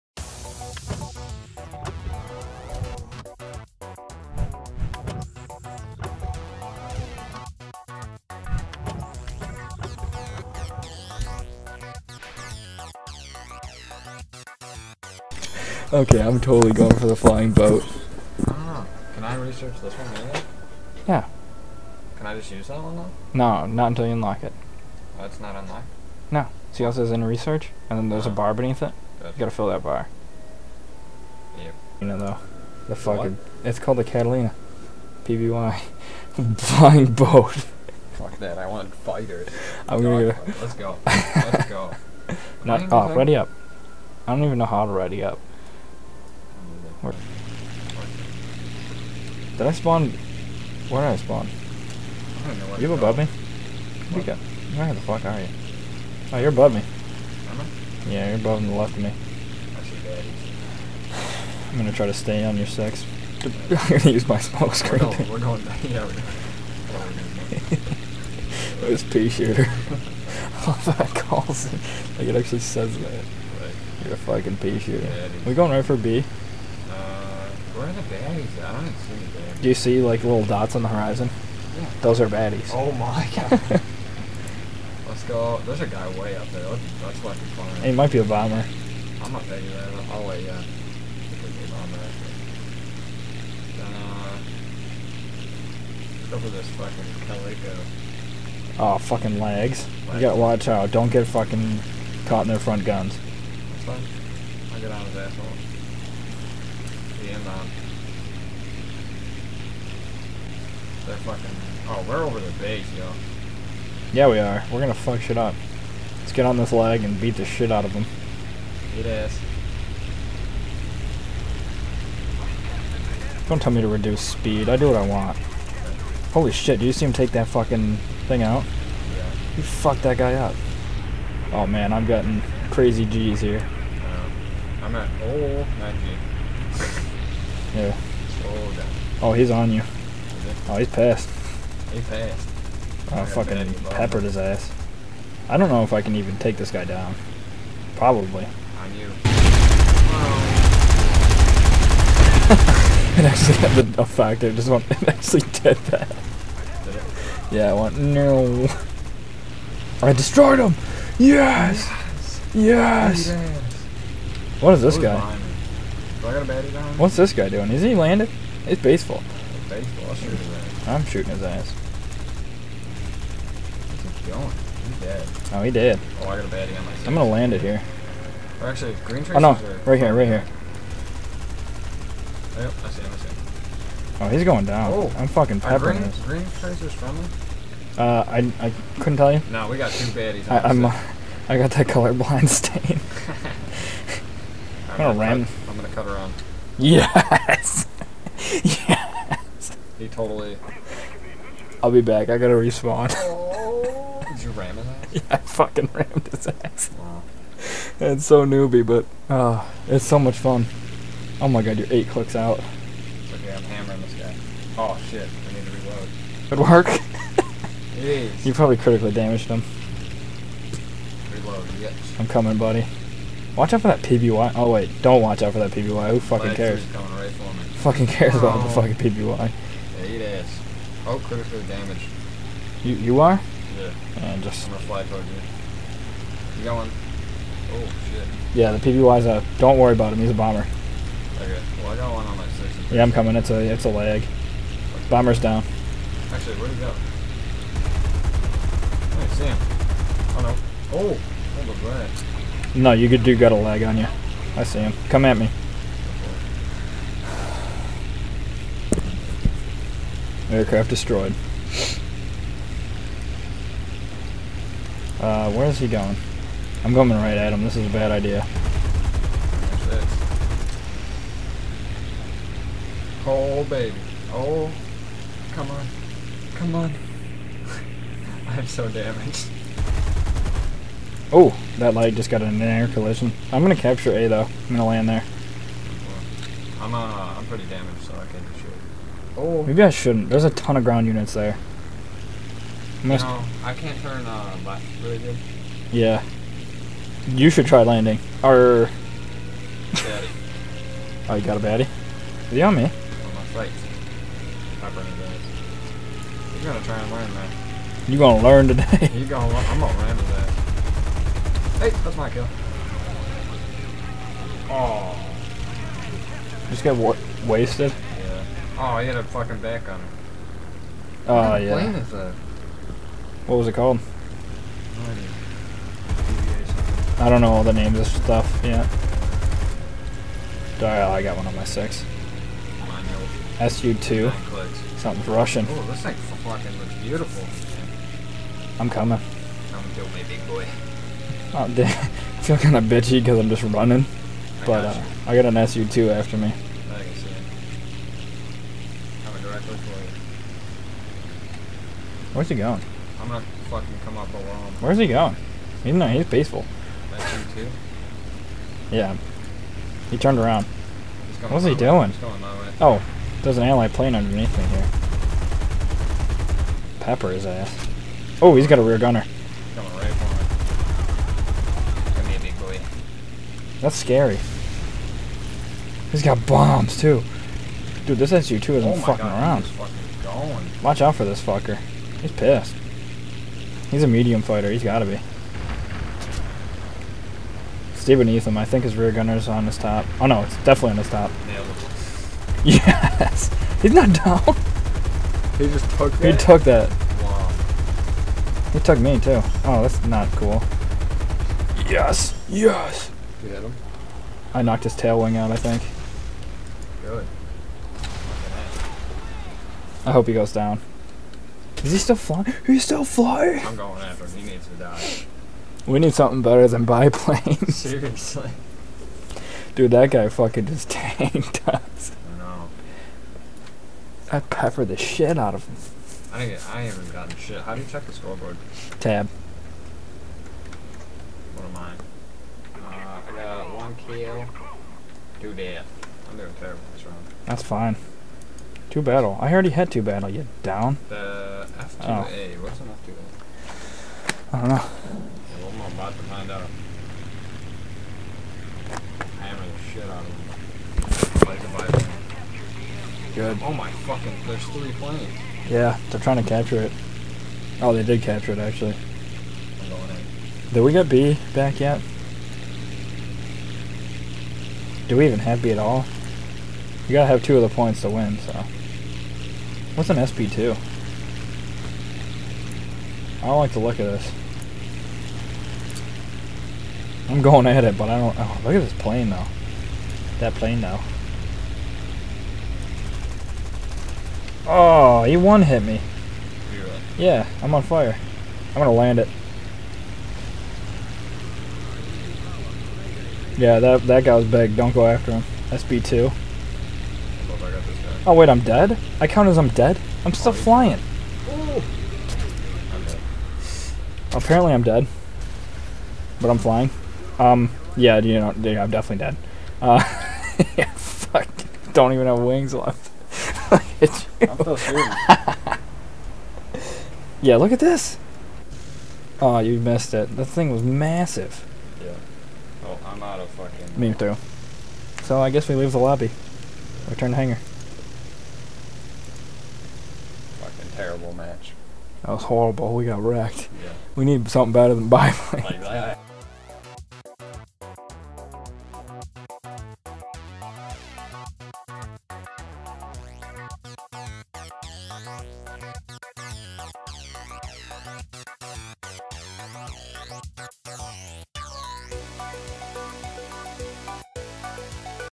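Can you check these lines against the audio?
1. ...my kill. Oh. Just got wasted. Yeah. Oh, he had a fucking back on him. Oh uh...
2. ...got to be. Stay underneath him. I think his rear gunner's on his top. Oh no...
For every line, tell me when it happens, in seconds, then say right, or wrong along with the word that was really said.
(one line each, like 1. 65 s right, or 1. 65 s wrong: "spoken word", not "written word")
1. 312 s right
2. 384 s wrong: "beneath", not "underneath".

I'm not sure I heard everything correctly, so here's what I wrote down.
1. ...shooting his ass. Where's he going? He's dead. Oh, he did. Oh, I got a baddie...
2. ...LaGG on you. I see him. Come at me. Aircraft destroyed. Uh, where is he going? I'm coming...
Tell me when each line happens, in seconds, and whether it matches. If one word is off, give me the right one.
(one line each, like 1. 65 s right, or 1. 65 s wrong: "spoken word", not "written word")
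1. 171 s right
2. 253 s right.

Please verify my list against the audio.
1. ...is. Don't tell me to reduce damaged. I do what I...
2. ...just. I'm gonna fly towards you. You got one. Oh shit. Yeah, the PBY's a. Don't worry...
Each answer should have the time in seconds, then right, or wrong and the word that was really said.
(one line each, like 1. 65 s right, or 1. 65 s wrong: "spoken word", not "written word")
1. 119 s wrong: "speed", not "damaged"
2. 234 s right.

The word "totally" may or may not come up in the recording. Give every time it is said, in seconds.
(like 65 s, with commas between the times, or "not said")
16 s, 200 s.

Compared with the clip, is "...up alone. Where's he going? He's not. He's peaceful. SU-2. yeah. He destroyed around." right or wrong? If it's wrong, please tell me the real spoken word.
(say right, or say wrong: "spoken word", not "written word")
wrong: "turned", not "destroyed".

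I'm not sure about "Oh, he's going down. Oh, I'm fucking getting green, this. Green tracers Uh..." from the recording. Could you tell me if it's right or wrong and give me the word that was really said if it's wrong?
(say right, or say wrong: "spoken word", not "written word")
wrong: "peppering", not "getting".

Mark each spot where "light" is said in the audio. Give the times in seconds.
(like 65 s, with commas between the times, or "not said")
281 s.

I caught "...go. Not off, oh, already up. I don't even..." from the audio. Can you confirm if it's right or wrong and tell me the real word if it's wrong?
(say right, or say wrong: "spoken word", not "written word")
wrong: "ready", not "already".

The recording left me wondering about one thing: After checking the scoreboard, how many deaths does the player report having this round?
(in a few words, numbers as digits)
2.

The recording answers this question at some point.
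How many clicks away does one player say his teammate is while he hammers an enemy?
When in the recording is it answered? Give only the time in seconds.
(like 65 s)
211 s.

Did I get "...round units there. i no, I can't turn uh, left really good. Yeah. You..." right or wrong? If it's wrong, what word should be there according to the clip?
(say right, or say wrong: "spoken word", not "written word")
wrong: "ground", not "round".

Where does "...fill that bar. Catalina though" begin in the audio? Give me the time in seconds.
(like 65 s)
29 s.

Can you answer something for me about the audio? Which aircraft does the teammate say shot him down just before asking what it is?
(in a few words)
F2A.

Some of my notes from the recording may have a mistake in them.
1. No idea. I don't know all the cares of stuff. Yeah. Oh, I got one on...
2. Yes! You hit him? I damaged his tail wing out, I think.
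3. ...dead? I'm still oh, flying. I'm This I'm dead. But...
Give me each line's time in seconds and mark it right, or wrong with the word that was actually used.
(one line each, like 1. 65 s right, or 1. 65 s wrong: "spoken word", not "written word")
1. 324 s wrong: "names", not "cares"
2. 402 s wrong: "knocked", not "damaged"
3. 499 s wrong: "Apparently", not "This".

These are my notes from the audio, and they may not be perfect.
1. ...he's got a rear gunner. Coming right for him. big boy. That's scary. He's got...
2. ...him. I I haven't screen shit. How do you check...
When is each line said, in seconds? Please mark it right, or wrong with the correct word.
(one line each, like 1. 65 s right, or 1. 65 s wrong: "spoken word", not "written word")
1. 368 s right
2. 425 s wrong: "gotten", not "screen".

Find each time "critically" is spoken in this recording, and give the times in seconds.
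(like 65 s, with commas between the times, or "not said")
218 s, 231 s.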